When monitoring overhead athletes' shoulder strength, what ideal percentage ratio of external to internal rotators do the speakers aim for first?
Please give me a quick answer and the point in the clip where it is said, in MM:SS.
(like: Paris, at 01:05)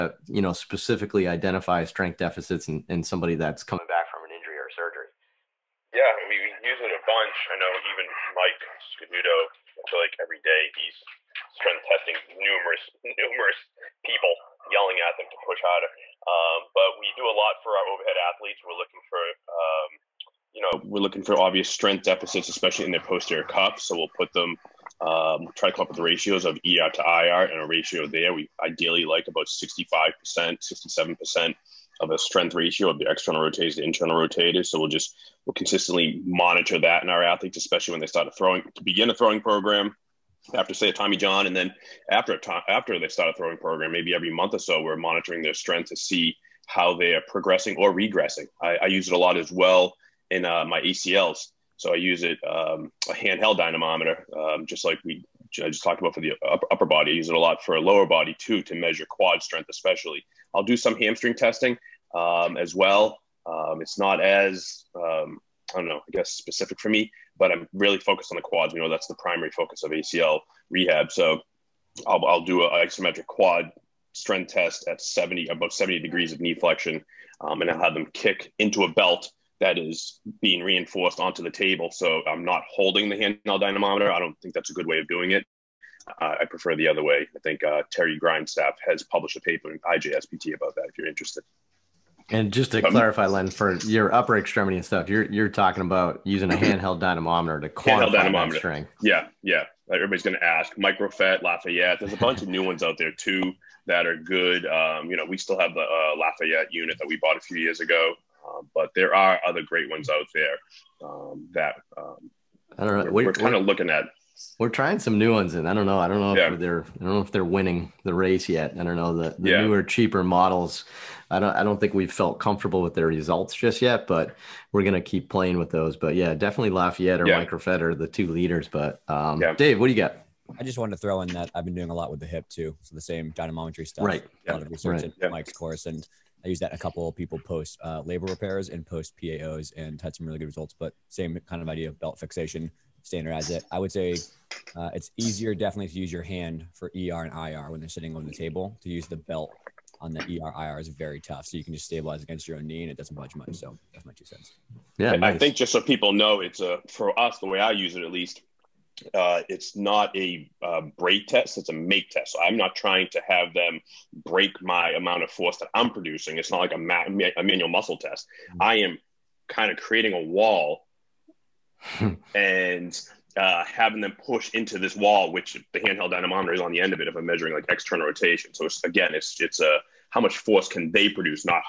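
65%, at 00:29.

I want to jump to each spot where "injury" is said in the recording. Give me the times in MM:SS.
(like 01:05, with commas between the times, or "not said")
00:04.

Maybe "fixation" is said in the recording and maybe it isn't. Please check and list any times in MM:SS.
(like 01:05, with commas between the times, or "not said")
02:22.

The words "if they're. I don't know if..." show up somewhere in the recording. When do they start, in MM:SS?
01:56.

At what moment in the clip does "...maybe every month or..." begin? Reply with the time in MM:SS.
00:43.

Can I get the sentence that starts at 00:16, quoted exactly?
Um, but we do a lot for our overhead athletes.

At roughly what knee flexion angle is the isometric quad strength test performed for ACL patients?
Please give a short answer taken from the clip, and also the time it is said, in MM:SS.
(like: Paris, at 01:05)
70 degrees, at 01:15.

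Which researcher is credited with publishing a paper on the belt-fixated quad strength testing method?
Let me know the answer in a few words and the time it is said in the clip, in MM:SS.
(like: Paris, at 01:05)
Terry Grindstaff, at 01:27.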